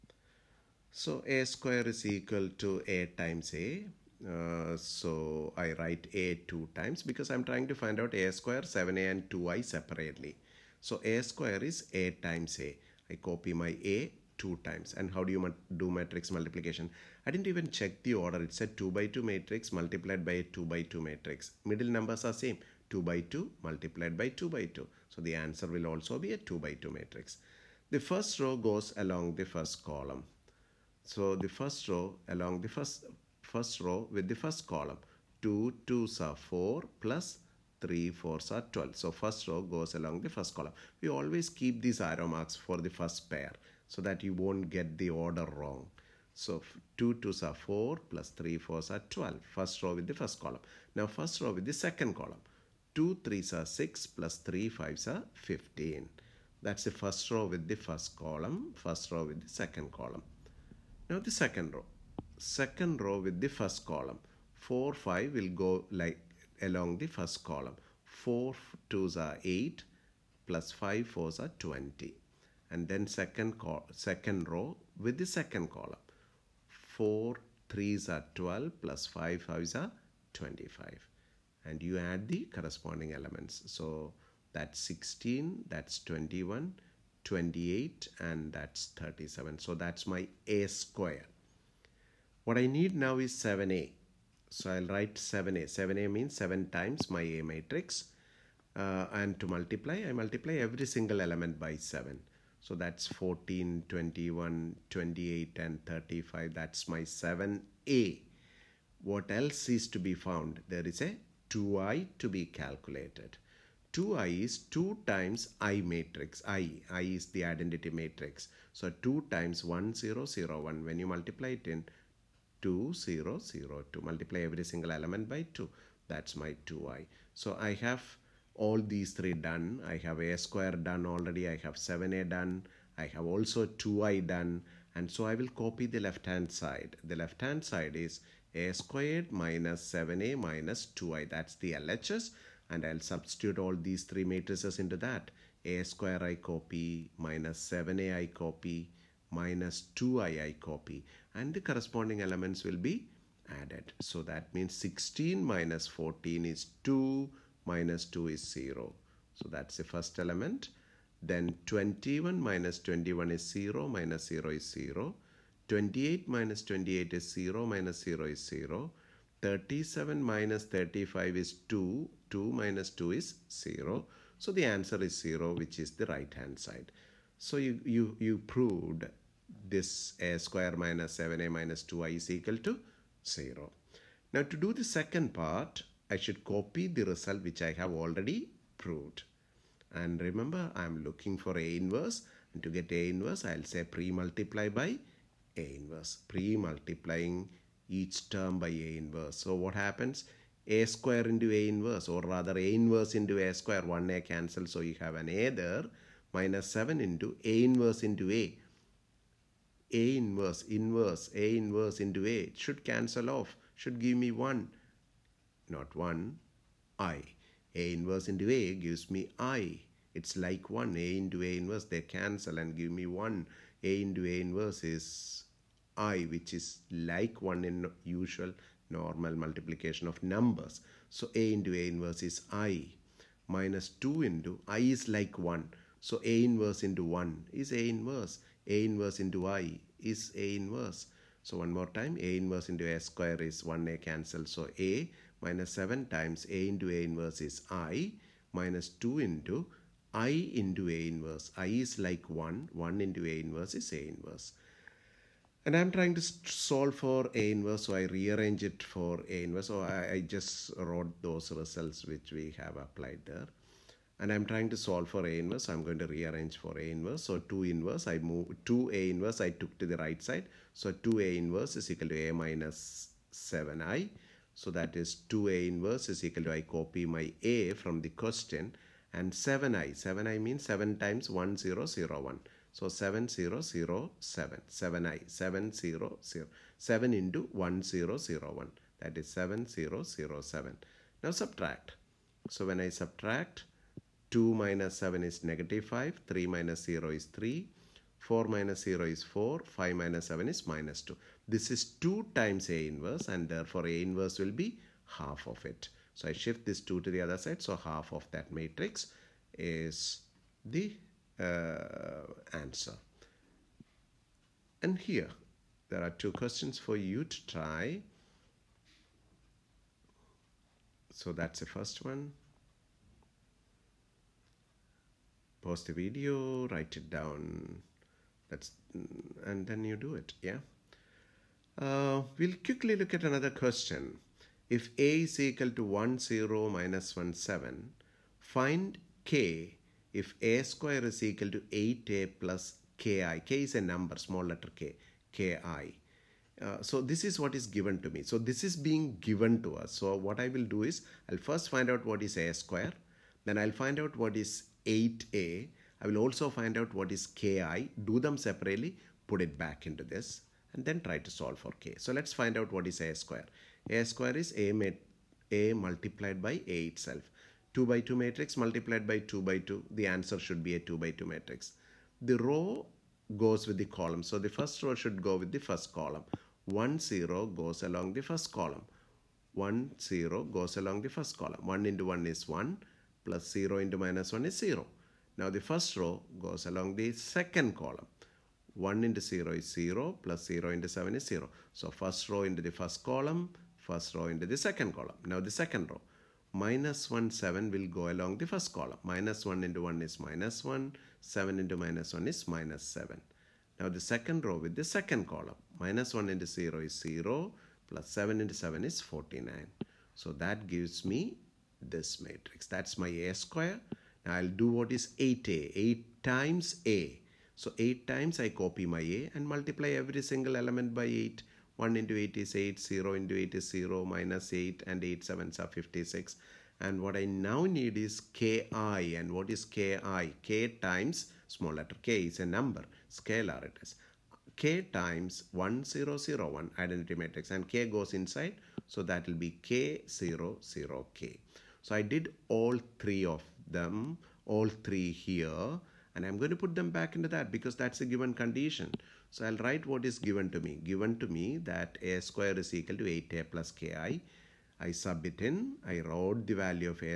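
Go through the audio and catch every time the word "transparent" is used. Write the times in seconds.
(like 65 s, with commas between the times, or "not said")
not said.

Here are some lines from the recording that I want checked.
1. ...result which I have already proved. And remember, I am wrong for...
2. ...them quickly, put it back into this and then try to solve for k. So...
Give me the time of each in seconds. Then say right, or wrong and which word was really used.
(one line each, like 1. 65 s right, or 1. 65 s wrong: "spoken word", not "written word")
1. 187 s wrong: "looking", not "wrong"
2. 358 s wrong: "separately", not "quickly".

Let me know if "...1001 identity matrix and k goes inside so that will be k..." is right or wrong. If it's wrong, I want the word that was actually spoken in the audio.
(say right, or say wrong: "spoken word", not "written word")
right.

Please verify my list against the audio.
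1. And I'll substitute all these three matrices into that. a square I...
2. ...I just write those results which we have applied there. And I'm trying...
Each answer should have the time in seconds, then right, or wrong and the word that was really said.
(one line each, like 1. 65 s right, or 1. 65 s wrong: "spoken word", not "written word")
1. 142 s right
2. 260 s wrong: "wrote", not "write".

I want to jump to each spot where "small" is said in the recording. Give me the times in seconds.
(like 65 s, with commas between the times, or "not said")
344 s, 431 s.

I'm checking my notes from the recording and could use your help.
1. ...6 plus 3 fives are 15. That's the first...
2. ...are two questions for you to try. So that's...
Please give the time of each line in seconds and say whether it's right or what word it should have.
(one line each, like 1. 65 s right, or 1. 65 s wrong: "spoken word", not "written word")
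1. 53 s right
2. 316 s right.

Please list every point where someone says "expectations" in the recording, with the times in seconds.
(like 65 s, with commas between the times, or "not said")
not said.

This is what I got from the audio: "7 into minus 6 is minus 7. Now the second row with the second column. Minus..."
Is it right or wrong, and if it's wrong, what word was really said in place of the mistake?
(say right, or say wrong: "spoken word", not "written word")
wrong: "1", not "6".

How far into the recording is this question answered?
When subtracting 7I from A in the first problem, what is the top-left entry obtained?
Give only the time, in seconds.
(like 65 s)
295 s.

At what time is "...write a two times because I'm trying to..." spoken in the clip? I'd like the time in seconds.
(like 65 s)
5 s.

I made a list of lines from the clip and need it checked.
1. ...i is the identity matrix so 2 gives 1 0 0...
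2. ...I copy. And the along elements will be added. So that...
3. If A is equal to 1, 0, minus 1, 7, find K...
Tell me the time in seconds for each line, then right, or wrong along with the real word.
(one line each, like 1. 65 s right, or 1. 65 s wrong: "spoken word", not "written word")
1. 116 s wrong: "times", not "gives"
2. 150 s wrong: "corresponding", not "along"
3. 334 s right.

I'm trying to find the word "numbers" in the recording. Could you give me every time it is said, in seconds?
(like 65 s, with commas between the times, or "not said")
21 s, 230 s, 343 s, 432 s.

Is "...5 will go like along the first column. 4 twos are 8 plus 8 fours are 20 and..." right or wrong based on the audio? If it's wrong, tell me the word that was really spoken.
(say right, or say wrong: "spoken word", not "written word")
wrong: "5", not "8".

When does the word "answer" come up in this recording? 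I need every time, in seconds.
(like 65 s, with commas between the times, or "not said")
25 s, 174 s, 312 s, 370 s.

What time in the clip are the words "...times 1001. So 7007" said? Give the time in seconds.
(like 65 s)
280 s.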